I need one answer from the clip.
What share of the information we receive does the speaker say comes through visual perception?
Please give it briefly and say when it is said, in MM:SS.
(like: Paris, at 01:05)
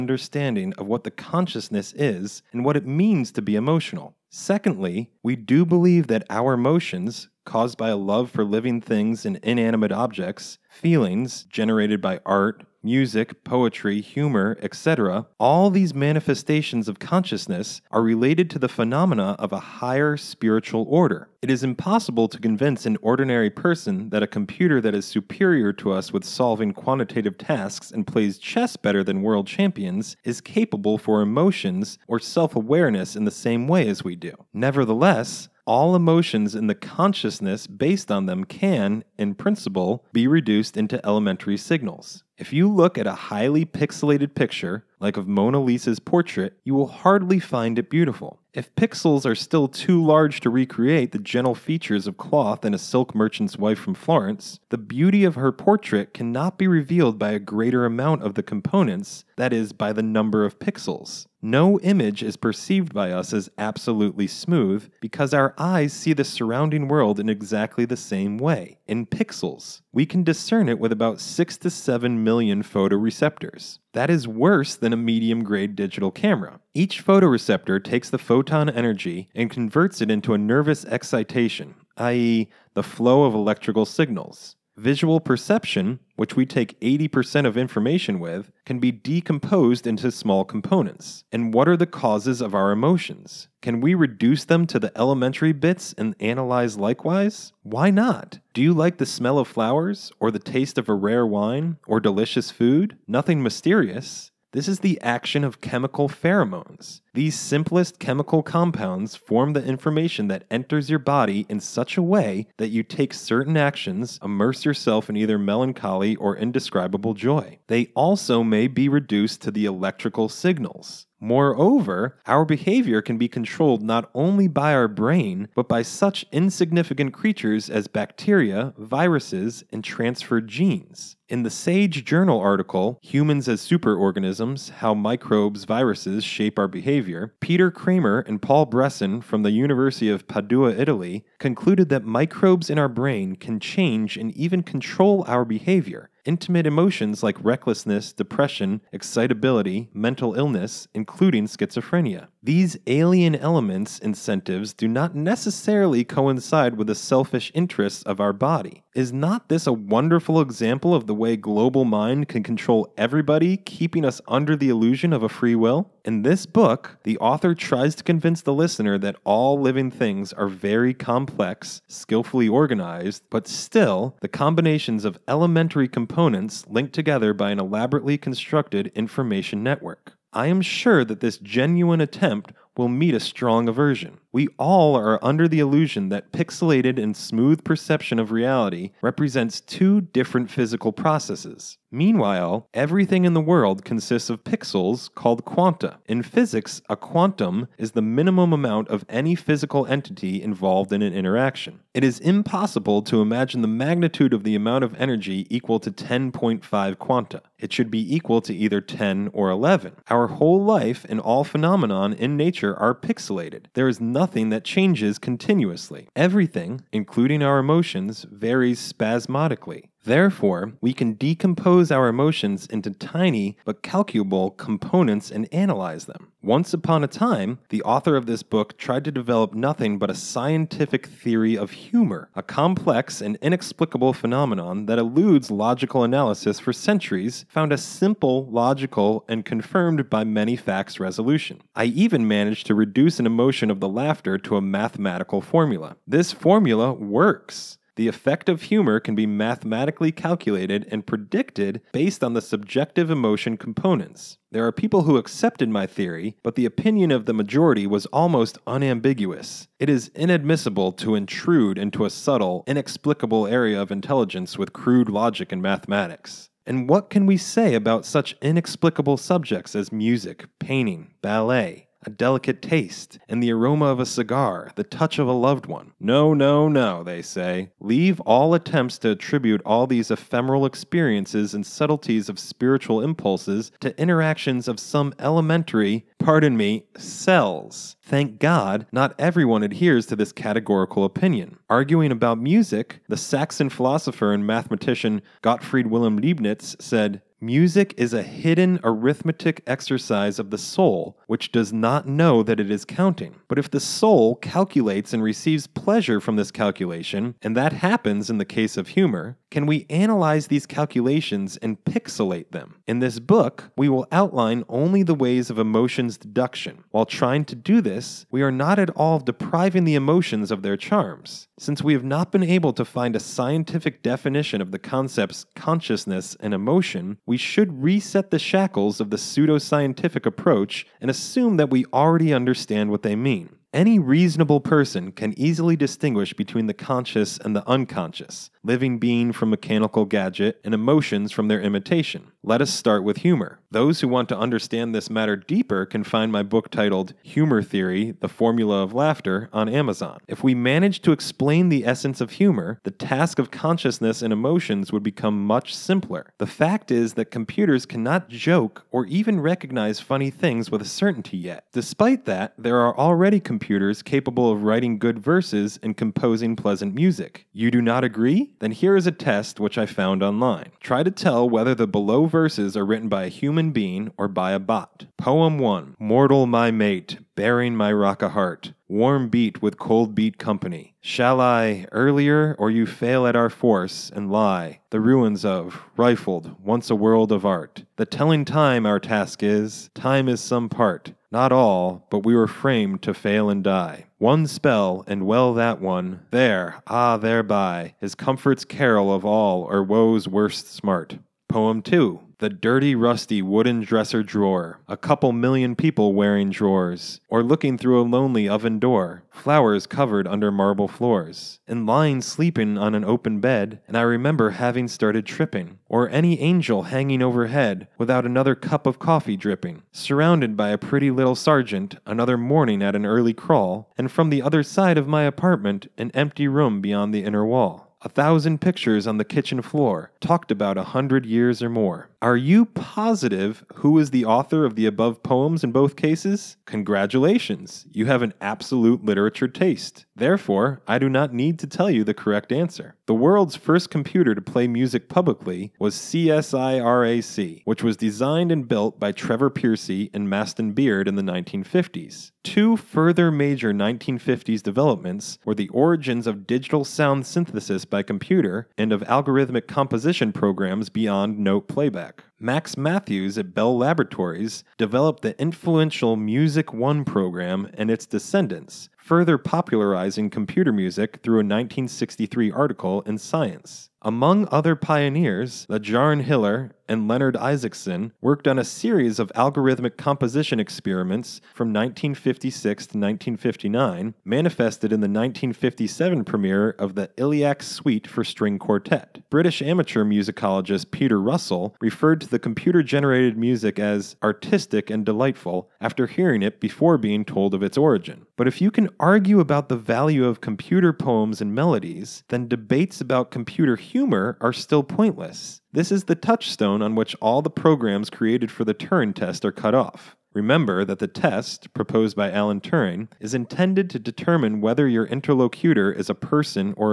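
80%, at 01:26.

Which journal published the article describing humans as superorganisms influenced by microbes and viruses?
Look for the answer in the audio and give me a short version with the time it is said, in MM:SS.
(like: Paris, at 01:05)
Sage Journal, at 02:11.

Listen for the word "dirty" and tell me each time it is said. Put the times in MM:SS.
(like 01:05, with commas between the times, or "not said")
06:42.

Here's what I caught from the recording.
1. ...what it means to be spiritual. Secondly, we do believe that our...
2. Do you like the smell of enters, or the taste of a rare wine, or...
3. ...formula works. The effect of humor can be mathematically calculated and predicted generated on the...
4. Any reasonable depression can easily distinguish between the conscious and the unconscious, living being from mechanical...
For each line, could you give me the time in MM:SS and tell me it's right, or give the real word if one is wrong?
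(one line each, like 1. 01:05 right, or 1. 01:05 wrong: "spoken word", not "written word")
1. 00:02 wrong: "emotional", not "spiritual"
2. 01:38 wrong: "flowers", not "enters"
3. 04:06 wrong: "based", not "generated"
4. 05:33 wrong: "person", not "depression".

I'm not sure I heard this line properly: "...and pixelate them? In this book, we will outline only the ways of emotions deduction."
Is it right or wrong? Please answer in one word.
right.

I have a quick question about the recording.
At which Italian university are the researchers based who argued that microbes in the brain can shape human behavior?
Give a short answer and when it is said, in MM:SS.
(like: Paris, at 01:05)
University of Padua, at 02:19.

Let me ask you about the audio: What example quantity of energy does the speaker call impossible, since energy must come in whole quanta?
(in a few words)
10.5 quanta.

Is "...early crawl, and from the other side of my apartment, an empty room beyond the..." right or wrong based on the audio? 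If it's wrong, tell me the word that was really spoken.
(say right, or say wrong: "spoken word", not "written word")
right.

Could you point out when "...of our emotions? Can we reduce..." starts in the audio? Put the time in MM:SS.
01:32.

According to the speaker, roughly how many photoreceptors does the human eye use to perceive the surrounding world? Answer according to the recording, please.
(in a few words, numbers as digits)
6 to 7 million.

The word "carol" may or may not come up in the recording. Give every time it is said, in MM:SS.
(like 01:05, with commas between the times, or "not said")
06:38.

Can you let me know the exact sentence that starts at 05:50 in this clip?
If we managed to explain the essence of humor, the task of consciousness and emotions would become much simpler.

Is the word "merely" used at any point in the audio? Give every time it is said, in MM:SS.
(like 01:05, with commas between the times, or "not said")
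not said.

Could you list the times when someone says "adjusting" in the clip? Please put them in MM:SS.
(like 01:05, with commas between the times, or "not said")
not said.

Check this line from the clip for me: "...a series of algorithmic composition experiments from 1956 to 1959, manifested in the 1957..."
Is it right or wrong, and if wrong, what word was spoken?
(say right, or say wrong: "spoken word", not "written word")
right.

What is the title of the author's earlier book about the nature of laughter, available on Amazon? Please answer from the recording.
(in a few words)
Humor Theory The Formula of Laughter.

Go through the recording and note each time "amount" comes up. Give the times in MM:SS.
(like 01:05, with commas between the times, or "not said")
00:57, 03:18, 03:24.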